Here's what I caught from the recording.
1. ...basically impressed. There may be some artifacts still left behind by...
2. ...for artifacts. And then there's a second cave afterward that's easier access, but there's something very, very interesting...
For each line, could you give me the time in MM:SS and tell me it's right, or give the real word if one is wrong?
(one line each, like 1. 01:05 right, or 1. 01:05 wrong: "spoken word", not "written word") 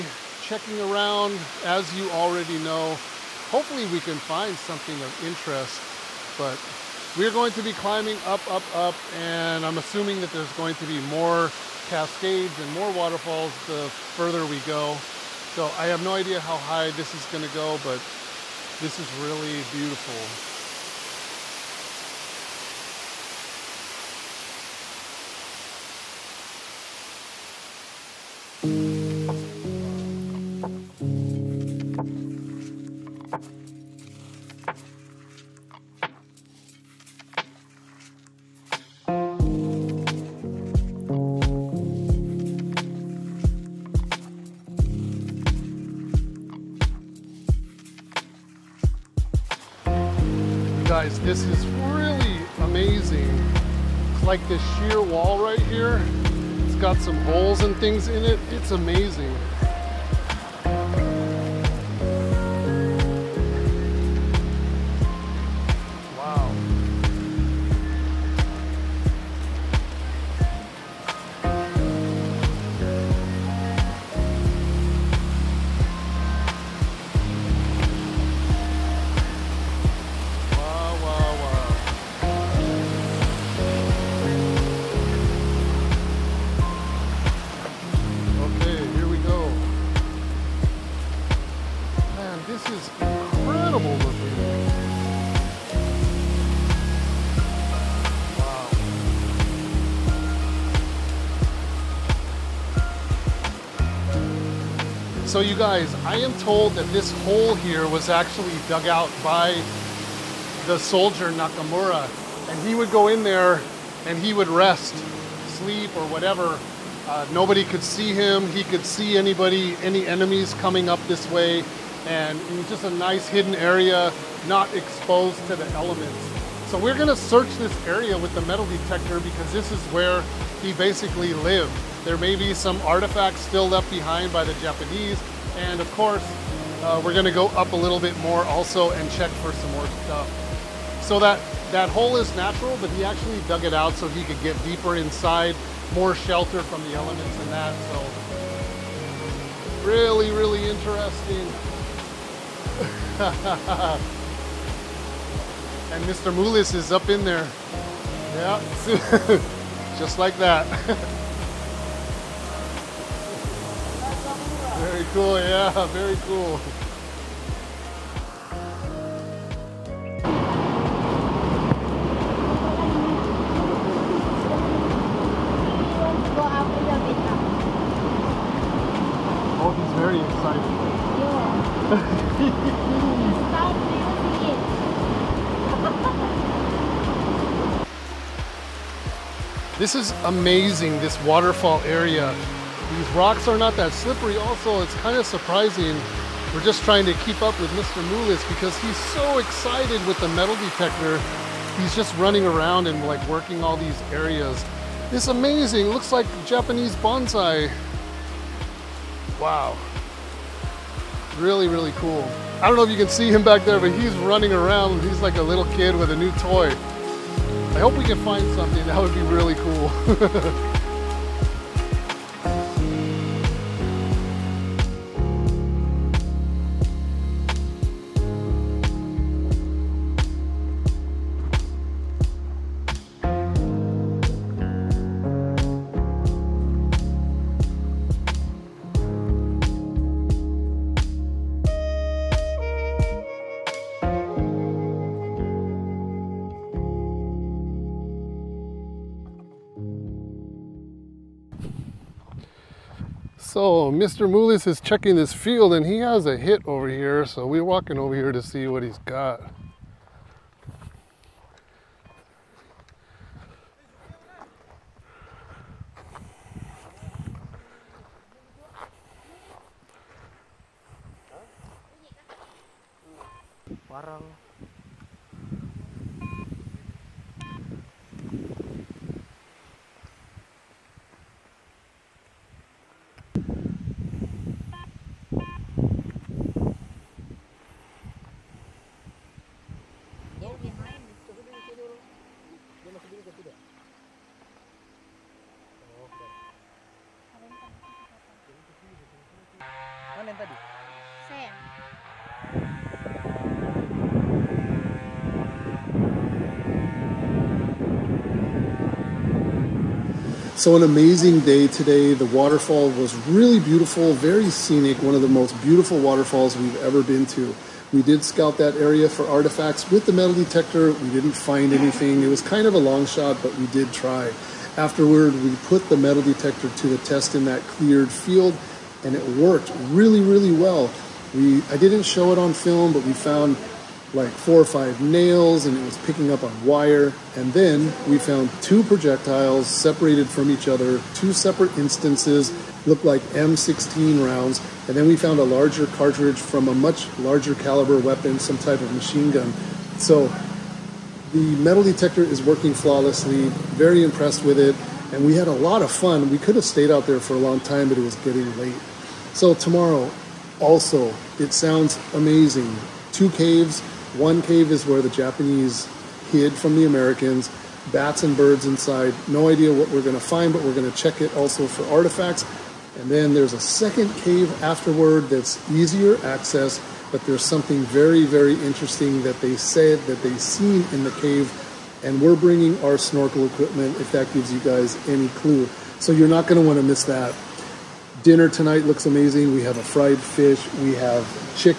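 1. 02:10 wrong: "lived", not "impressed"
2. 06:11 right.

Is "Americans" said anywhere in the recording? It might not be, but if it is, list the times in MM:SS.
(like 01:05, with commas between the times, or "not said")
06:06.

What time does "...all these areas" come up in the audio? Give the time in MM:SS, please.
03:23.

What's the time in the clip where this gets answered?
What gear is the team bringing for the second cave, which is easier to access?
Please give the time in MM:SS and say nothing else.
06:22.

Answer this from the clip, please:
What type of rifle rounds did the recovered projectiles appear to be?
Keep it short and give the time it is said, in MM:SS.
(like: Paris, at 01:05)
M16 rounds, at 05:43.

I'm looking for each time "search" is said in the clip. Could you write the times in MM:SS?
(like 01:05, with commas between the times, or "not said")
02:07.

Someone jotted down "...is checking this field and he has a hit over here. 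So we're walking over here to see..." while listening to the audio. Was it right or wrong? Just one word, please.
right.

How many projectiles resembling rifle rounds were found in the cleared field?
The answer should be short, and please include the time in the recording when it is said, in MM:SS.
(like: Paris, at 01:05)
2, at 05:38.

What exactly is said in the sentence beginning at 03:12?
These rocks are not that slippery.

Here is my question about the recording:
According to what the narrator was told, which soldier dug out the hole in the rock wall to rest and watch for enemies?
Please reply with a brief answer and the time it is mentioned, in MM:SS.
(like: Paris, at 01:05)
Nakamura, at 01:51.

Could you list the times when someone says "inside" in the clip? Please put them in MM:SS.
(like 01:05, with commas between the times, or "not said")
02:24, 06:08.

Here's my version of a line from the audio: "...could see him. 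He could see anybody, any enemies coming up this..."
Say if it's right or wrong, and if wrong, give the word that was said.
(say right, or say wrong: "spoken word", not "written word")
right.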